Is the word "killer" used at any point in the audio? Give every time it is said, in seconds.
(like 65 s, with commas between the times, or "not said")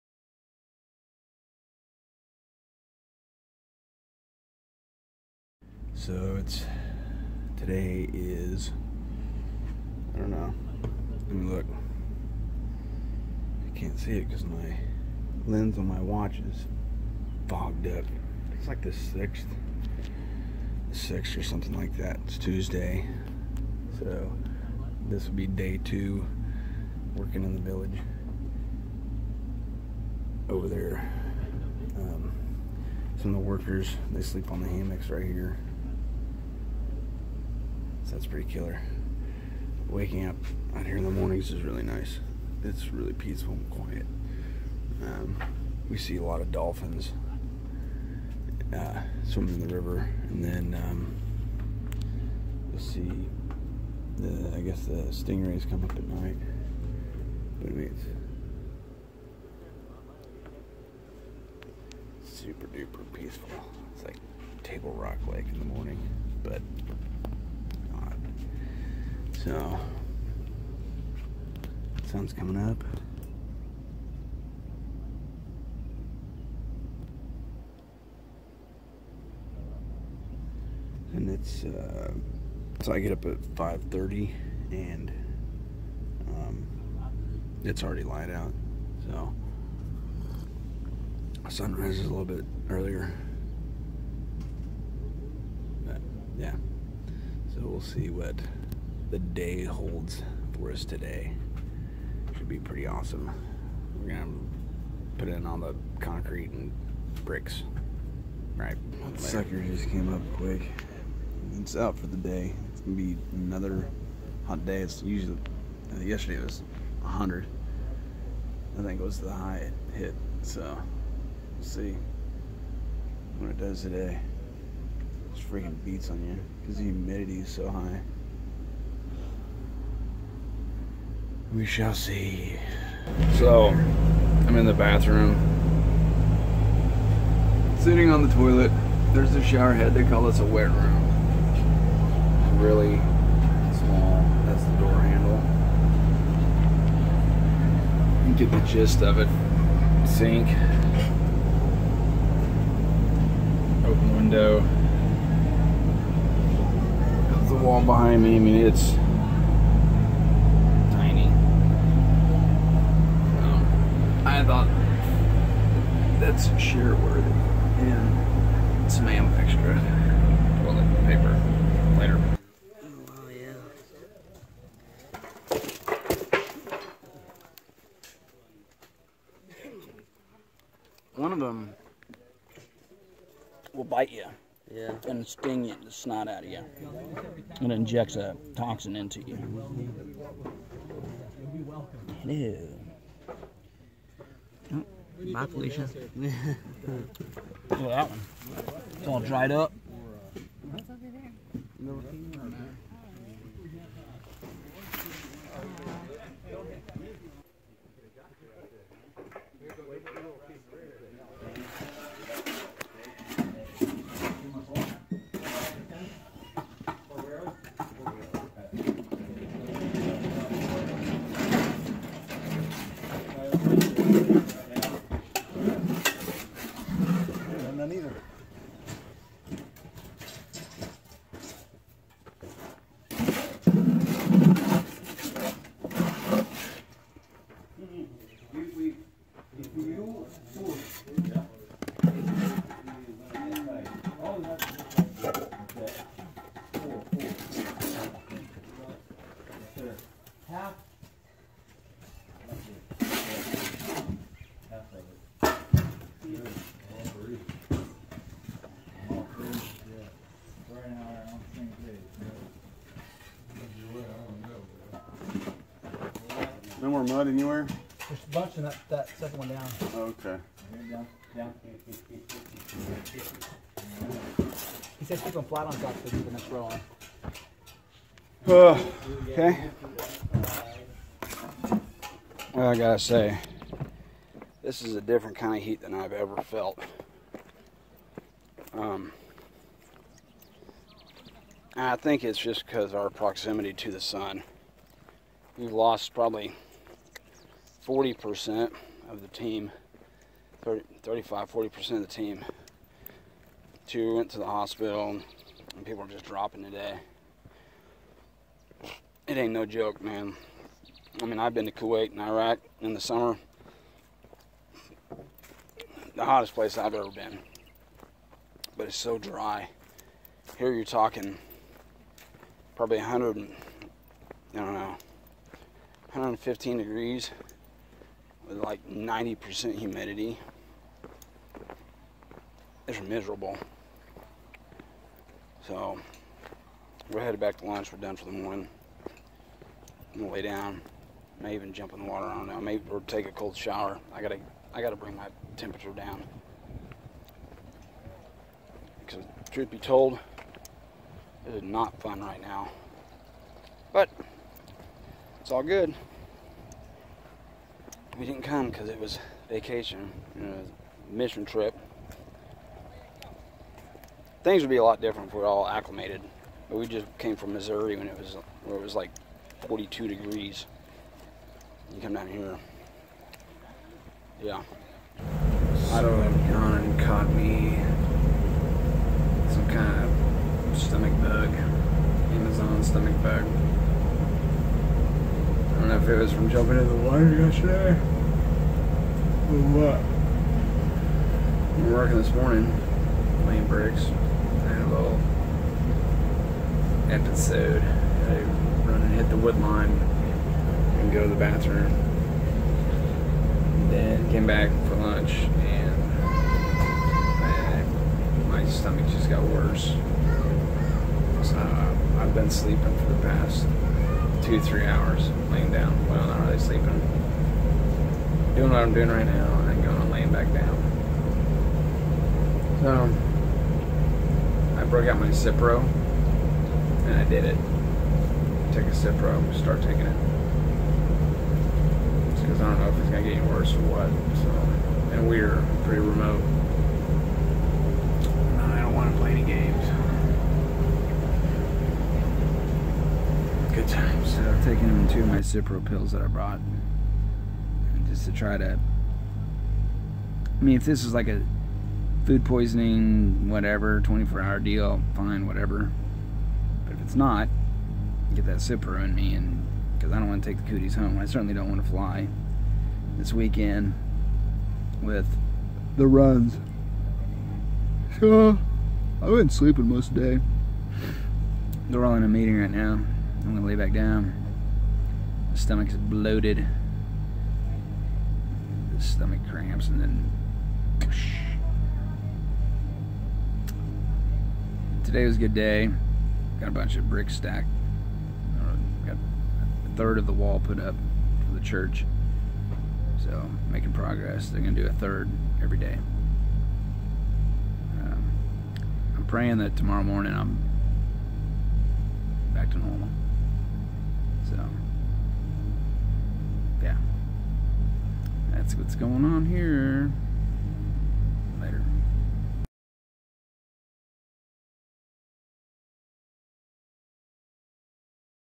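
38 s.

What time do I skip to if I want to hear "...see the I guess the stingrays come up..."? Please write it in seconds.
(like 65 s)
52 s.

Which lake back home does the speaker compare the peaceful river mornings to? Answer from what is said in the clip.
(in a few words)
Table Rock Lake.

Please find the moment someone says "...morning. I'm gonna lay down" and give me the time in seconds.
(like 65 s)
338 s.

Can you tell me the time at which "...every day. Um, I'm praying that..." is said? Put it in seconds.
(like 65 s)
495 s.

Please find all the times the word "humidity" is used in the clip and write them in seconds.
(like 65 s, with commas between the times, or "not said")
126 s, 329 s.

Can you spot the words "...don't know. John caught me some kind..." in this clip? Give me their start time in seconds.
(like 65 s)
376 s.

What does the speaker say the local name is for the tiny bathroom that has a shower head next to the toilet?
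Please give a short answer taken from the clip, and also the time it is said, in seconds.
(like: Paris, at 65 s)
wet room, at 140 s.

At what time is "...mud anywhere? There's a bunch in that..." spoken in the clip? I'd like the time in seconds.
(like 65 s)
267 s.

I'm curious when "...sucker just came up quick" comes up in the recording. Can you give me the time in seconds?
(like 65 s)
109 s.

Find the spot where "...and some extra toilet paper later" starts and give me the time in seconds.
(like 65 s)
167 s.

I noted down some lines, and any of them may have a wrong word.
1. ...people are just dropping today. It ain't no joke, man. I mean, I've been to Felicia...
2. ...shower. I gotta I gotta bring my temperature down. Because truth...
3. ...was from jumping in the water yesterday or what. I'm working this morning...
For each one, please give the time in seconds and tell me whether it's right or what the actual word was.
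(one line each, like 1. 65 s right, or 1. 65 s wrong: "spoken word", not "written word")
1. 305 s wrong: "Kuwait", not "Felicia"
2. 343 s right
3. 386 s right.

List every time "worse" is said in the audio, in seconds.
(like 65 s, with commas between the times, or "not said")
409 s, 433 s.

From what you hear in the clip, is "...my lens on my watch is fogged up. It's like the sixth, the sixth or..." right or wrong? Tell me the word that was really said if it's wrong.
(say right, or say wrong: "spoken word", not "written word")
right.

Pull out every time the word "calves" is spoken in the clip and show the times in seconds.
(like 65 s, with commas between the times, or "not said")
not said.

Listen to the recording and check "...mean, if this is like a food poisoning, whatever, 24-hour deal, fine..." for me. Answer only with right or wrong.
right.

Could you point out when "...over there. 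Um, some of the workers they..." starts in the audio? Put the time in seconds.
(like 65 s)
30 s.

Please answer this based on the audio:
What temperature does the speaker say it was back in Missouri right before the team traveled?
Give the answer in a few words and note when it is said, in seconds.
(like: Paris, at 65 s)
42 degrees, at 369 s.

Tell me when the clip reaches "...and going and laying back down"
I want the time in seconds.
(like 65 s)
419 s.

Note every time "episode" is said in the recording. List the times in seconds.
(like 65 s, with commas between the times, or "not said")
397 s.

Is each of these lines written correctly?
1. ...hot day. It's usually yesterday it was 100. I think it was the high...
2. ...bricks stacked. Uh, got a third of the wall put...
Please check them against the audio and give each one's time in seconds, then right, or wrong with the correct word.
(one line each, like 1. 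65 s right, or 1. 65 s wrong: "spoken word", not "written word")
1. 114 s right
2. 487 s right.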